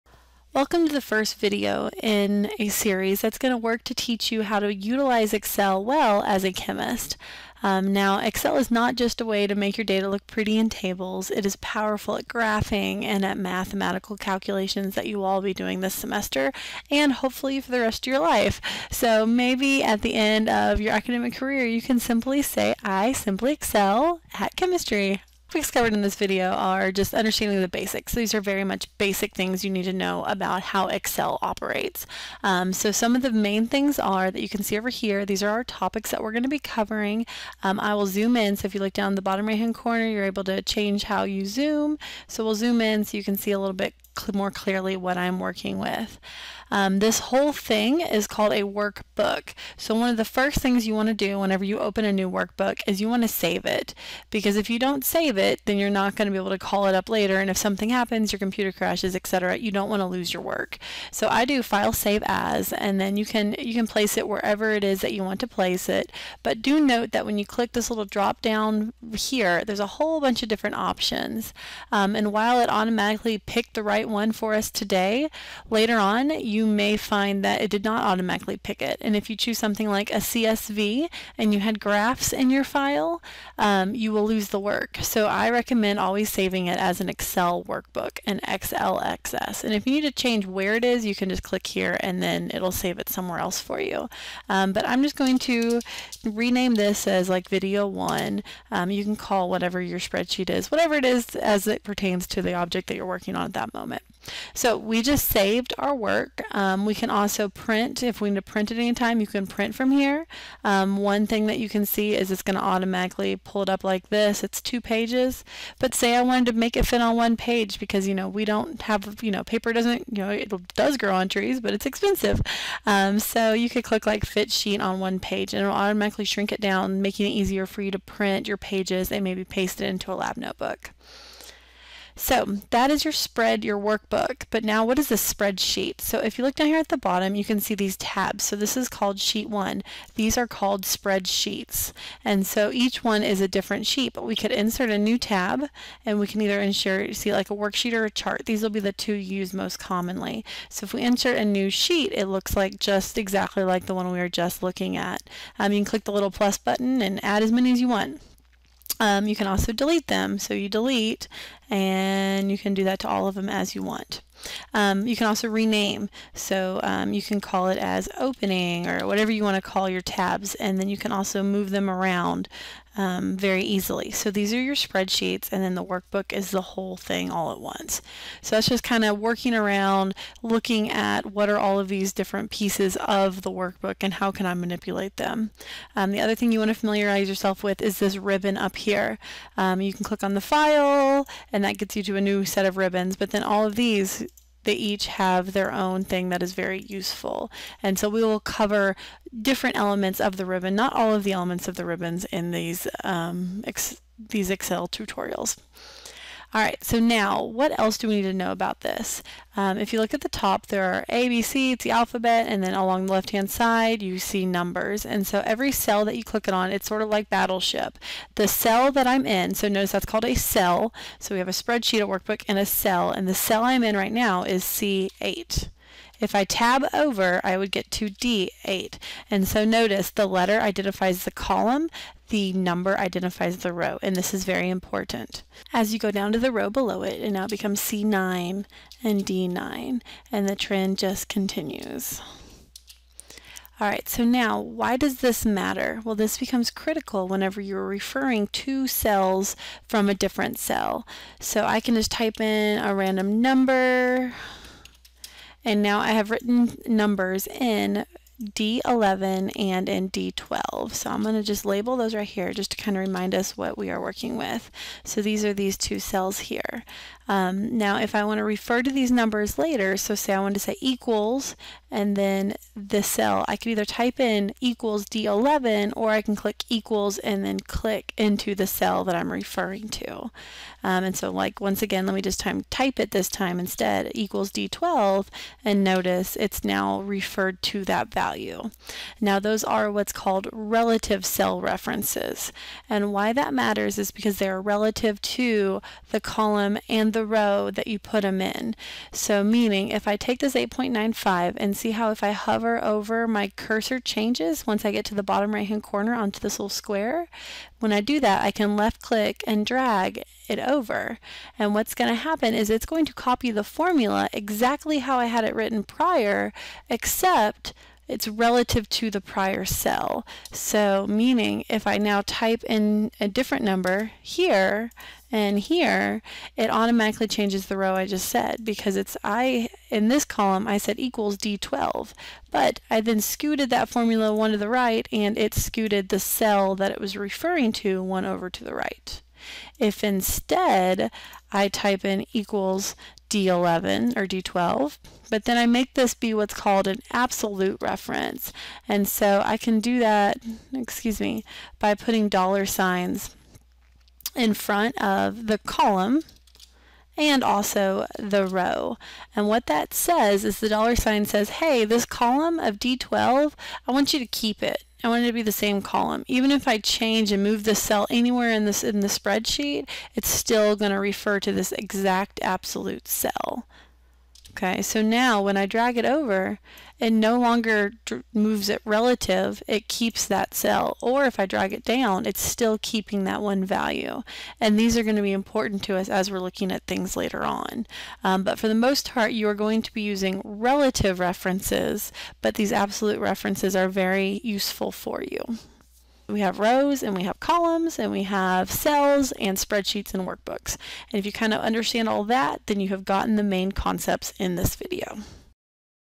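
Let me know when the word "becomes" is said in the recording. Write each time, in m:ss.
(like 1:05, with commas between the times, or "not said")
3:57, 4:06.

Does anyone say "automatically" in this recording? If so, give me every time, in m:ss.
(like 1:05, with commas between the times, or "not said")
1:12, 1:18, 1:52, 2:05, 5:26.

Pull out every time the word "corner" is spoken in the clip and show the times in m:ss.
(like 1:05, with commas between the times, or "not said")
0:39, 5:05.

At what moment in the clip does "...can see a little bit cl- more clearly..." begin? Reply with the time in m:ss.
0:43.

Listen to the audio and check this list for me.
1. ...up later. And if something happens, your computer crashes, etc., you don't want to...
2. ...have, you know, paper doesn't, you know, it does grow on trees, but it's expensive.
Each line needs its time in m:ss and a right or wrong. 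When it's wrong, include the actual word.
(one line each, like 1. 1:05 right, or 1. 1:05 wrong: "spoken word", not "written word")
1. 0:56 right
2. 1:58 right.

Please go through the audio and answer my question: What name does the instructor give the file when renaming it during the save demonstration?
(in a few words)
video one.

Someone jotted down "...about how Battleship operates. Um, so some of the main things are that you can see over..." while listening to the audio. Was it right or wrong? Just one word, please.
wrong.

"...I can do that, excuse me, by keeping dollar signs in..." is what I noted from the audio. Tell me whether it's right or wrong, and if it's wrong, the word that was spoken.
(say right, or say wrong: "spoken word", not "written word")
wrong: "putting", not "keeping".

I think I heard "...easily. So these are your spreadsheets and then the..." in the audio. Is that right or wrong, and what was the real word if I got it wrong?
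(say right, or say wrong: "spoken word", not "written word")
right.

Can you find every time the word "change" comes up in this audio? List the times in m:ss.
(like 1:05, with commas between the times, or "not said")
0:40, 1:30, 5:03, 5:27, 6:06.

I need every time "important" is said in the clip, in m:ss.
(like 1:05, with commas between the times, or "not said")
3:54, 6:25.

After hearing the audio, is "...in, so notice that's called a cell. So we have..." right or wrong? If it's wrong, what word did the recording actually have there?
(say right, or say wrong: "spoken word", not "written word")
right.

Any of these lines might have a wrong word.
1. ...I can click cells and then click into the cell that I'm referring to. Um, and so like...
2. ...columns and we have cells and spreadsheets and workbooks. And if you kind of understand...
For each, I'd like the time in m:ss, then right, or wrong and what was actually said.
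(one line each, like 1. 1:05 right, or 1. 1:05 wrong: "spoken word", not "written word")
1. 4:36 wrong: "equals", not "cells"
2. 6:37 right.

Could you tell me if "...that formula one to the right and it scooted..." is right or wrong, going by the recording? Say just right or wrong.
right.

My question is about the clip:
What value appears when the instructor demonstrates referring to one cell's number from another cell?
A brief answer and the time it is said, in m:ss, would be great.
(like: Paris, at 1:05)
8.95, at 5:00.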